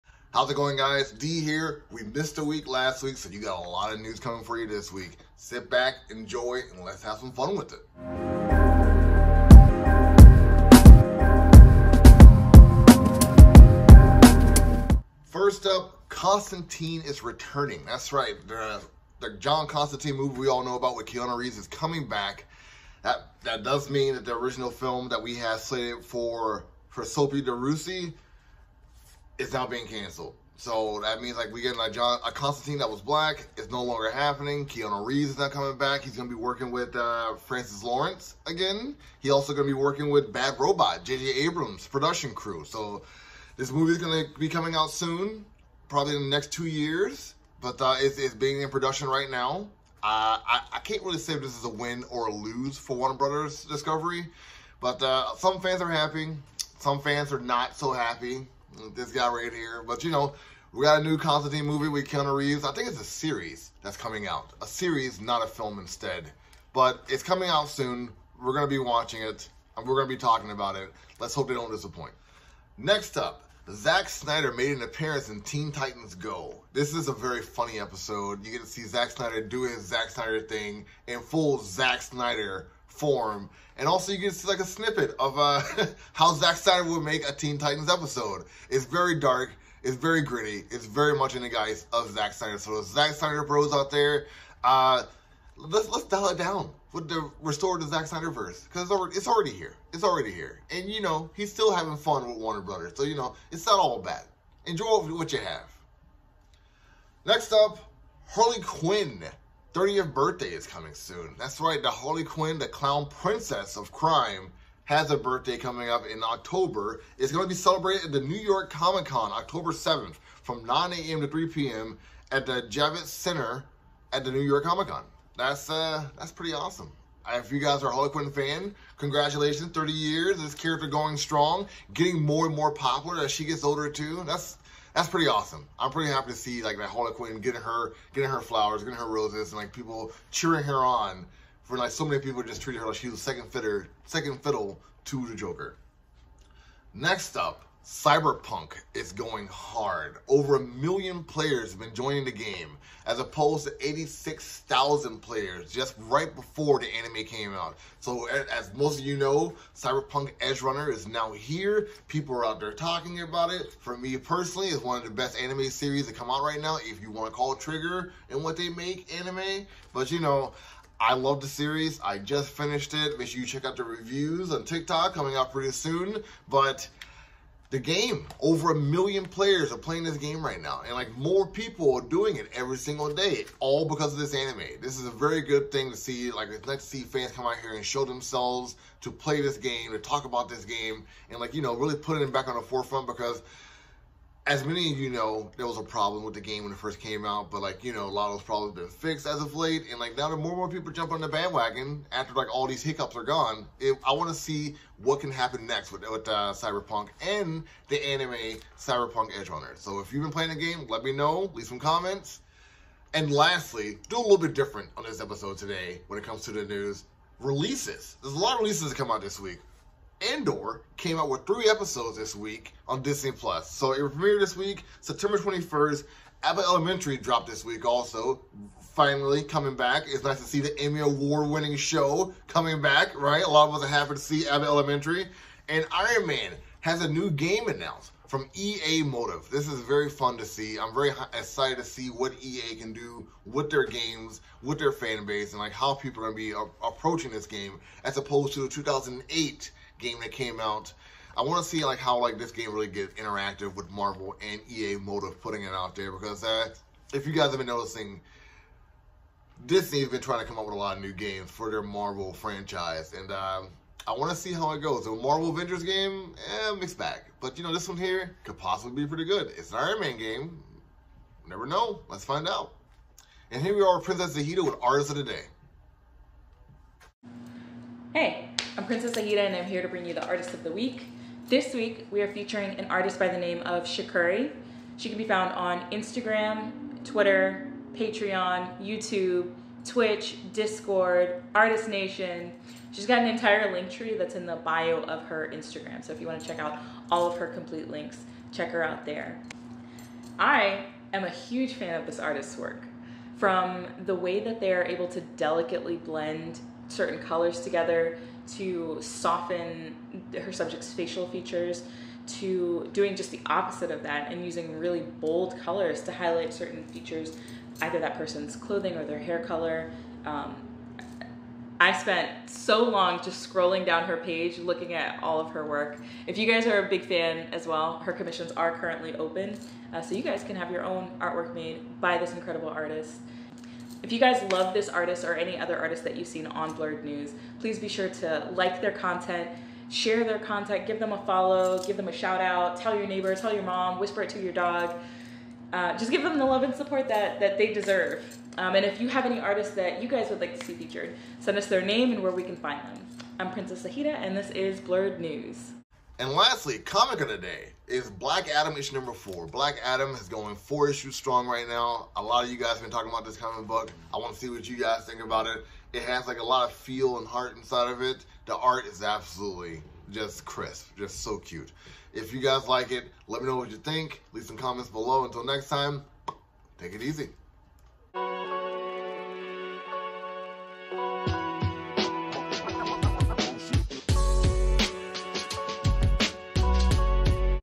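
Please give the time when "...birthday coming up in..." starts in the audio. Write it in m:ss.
1:55.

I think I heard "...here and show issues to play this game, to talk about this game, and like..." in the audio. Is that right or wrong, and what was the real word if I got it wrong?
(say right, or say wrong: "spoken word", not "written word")
wrong: "themselves", not "issues".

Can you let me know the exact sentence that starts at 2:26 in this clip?
Next up, Cyberpunk is going hard.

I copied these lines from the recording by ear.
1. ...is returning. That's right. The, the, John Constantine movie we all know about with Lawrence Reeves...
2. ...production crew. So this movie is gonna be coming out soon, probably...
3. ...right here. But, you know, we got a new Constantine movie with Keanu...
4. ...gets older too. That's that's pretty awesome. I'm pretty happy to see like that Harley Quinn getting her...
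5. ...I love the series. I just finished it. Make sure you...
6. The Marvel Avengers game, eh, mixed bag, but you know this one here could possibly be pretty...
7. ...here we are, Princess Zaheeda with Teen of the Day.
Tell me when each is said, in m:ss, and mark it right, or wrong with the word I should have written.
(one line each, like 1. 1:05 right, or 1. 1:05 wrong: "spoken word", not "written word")
1. 0:17 wrong: "Keanu", not "Lawrence"
2. 0:41 right
3. 0:59 right
4. 2:13 right
5. 2:50 right
6. 4:25 right
7. 4:33 wrong: "Artist", not "Teen".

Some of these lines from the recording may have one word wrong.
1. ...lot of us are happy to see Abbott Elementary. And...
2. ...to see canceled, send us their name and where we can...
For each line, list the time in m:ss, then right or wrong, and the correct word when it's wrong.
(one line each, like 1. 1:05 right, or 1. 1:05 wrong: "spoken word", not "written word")
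1. 3:53 right
2. 5:50 wrong: "featured", not "canceled".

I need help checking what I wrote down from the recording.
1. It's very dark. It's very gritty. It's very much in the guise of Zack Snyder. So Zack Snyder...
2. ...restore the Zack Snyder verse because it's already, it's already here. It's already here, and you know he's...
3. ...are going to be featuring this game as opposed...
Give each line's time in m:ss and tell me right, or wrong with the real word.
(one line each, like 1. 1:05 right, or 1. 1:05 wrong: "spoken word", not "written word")
1. 1:28 right
2. 1:37 right
3. 4:06 wrong: "approaching", not "featuring".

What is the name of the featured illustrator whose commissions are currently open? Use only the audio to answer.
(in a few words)
Shakuri.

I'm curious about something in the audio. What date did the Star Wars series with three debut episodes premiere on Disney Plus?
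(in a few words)
September 21st.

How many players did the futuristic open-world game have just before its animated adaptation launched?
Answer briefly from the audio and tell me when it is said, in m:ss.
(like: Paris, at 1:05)
86,000, at 2:33.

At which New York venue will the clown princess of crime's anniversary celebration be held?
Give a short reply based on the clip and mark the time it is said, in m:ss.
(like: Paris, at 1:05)
Javits Center, at 2:02.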